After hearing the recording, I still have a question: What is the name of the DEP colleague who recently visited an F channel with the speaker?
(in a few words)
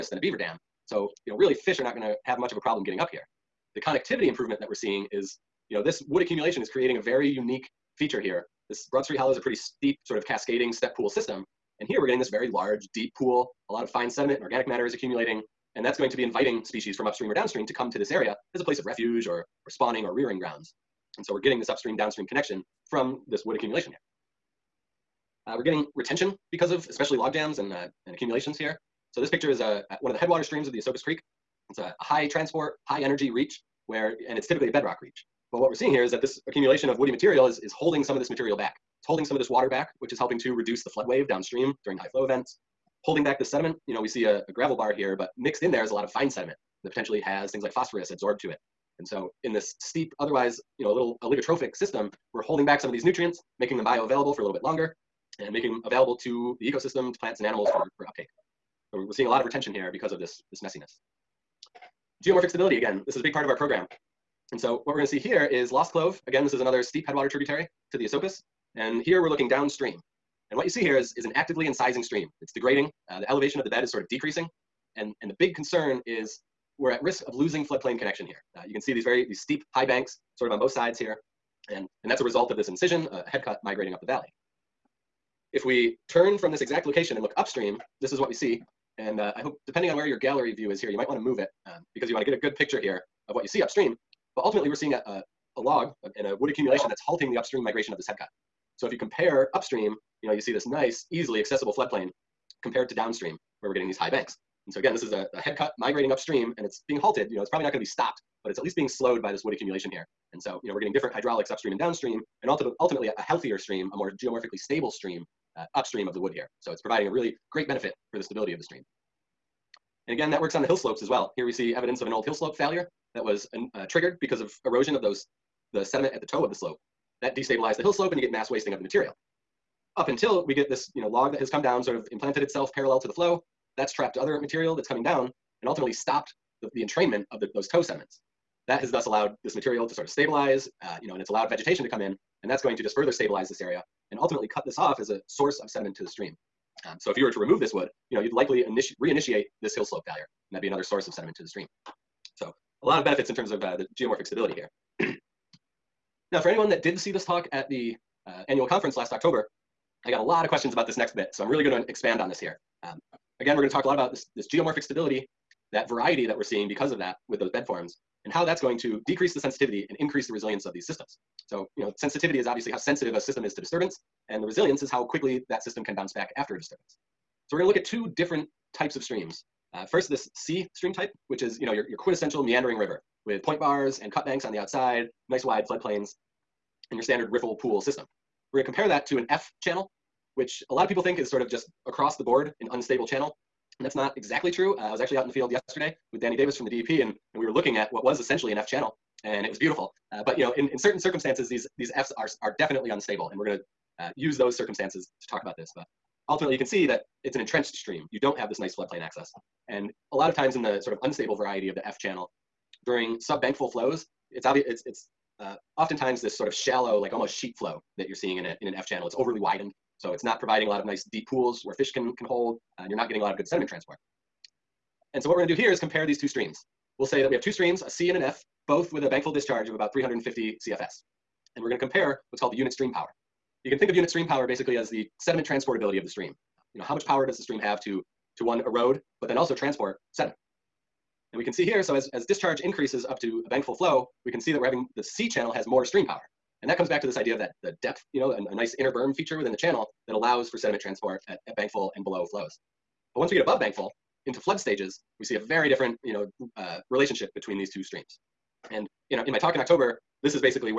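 Danny Davis.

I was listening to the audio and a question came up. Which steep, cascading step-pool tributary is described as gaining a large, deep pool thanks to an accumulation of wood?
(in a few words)
Broad Street Hollow.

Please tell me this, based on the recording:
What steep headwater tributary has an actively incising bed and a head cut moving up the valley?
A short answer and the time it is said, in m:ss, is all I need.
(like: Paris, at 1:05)
Lost Clove, at 1:05.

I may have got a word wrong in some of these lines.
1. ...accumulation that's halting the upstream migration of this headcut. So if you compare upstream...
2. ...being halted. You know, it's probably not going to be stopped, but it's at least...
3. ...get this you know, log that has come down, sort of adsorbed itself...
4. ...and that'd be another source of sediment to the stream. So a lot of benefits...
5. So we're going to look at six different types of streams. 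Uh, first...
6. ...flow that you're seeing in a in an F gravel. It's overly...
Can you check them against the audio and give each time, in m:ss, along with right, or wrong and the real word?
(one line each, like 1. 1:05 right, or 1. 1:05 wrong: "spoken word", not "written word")
1. 1:36 right
2. 1:46 right
3. 2:10 wrong: "implanted", not "adsorbed"
4. 2:30 right
5. 2:57 wrong: "two", not "six"
6. 3:37 wrong: "channel", not "gravel".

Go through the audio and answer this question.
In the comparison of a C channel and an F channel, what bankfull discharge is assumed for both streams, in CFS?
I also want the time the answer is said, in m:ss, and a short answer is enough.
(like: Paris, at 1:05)
350, at 3:49.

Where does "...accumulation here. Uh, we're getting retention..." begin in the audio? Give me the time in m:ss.
0:23.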